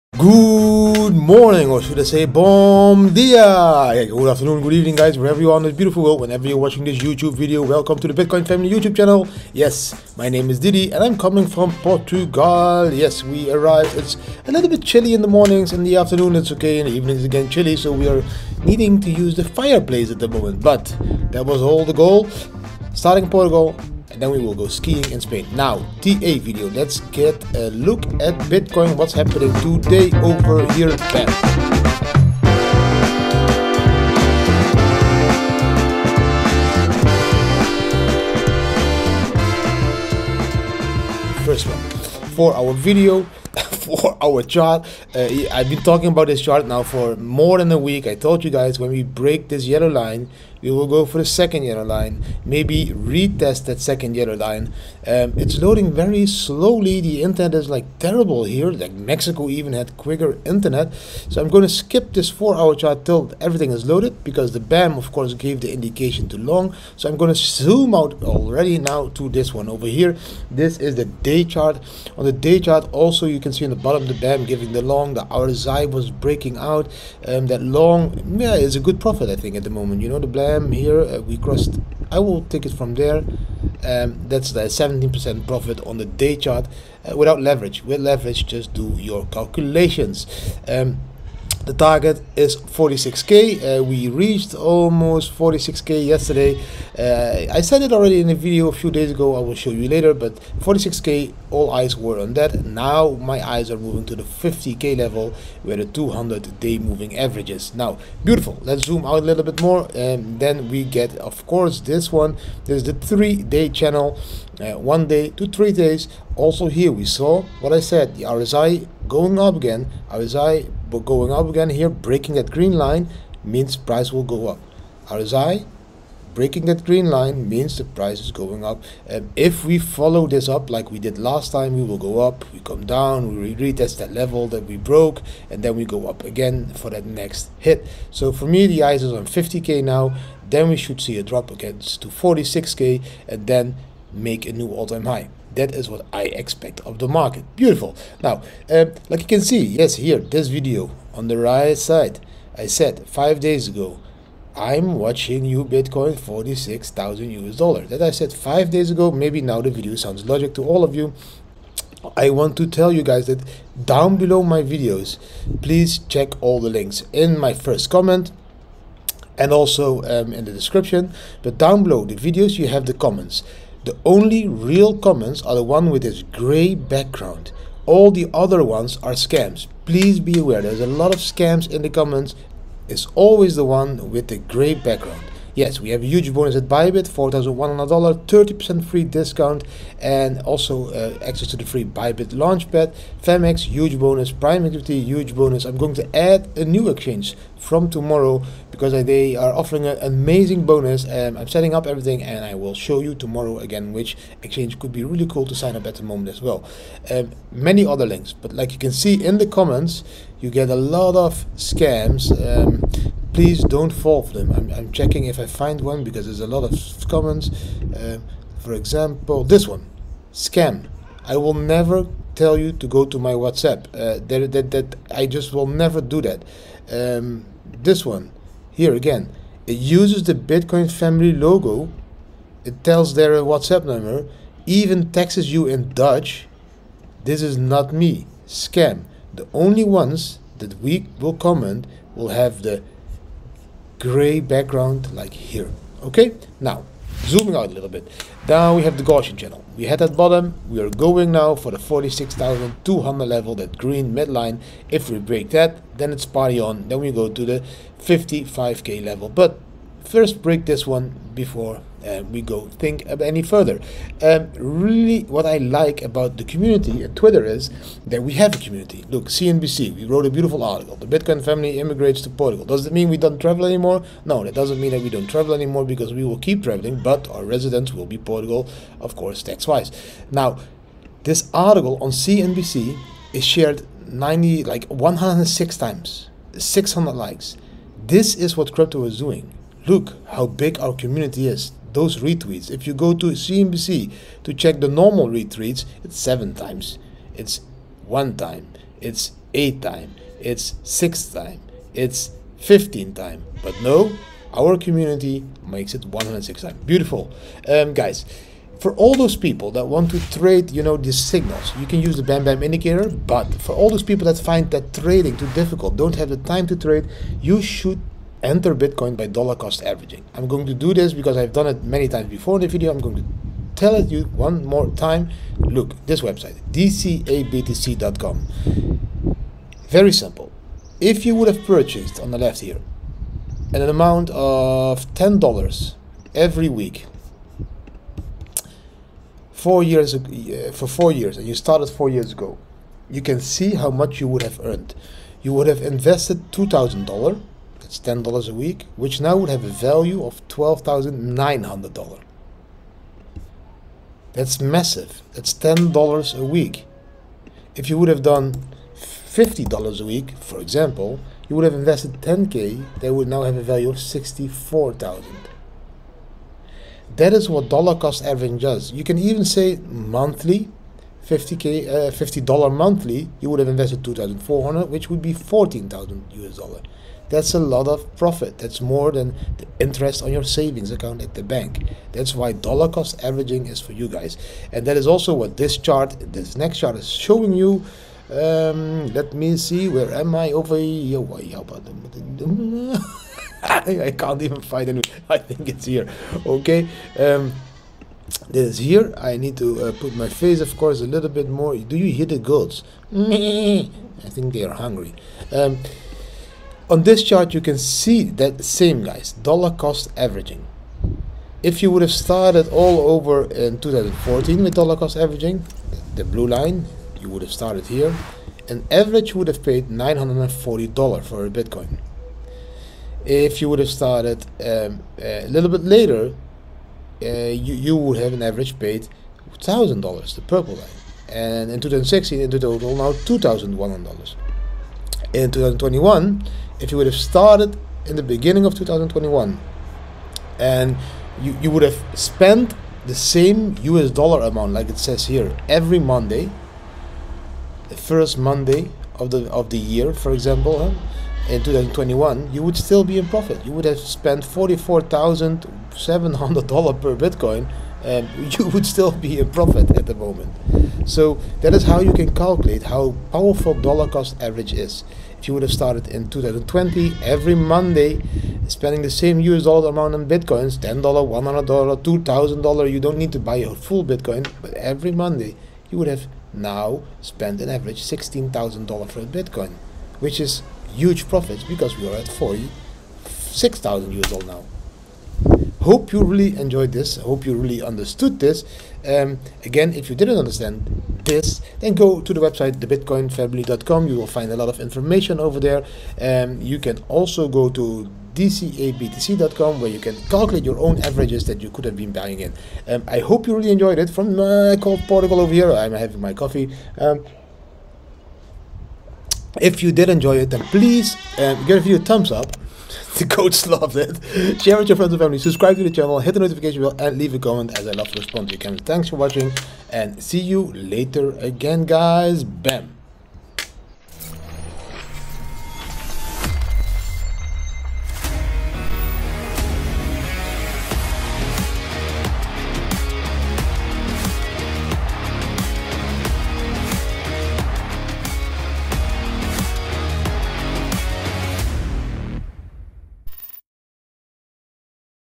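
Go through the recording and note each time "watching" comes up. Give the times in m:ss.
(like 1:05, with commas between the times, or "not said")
0:06, 2:34, 8:39.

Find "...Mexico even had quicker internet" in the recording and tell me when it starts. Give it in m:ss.
0:58.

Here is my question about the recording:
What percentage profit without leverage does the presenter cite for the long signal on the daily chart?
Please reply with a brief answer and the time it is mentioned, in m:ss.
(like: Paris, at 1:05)
17%, at 1:24.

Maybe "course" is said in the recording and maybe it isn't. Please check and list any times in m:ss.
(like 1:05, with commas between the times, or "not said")
1:05, 1:51, 4:39, 6:40.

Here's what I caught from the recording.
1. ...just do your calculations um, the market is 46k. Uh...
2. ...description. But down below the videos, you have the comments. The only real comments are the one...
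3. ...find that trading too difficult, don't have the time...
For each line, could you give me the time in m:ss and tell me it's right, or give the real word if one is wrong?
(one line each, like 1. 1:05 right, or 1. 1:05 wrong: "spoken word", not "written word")
1. 1:28 wrong: "target", not "market"
2. 2:50 right
3. 5:14 right.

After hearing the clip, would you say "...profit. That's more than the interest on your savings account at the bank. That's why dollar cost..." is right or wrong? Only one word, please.
right.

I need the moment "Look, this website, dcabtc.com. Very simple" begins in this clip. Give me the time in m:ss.
5:25.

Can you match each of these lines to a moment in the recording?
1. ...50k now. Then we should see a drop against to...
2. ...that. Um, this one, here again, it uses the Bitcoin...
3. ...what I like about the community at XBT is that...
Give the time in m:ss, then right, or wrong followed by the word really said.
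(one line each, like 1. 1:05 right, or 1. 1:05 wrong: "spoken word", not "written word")
1. 2:19 right
2. 3:46 right
3. 4:25 wrong: "Twitter", not "XBT".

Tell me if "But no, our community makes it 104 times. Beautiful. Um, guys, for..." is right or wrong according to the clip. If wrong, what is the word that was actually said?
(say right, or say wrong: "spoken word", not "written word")
wrong: "106", not "104".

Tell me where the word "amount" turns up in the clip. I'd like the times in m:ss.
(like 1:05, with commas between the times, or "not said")
5:33, 7:24, 7:49.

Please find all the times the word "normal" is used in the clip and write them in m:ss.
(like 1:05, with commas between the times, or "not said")
4:54.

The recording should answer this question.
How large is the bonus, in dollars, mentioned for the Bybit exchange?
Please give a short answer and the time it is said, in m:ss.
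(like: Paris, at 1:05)
$4,100, at 3:07.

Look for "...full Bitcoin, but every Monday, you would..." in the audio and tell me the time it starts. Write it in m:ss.
7:53.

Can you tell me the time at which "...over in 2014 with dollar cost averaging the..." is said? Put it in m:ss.
6:53.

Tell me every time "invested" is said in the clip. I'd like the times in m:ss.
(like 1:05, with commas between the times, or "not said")
5:45, 6:01, 6:13.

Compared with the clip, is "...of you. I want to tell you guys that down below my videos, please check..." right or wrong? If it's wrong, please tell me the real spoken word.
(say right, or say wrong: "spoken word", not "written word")
right.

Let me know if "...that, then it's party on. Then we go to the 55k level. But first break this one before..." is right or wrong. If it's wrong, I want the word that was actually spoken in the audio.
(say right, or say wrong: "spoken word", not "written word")
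right.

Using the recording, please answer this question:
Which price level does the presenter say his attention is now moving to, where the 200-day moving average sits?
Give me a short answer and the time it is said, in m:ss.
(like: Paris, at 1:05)
50k, at 1:44.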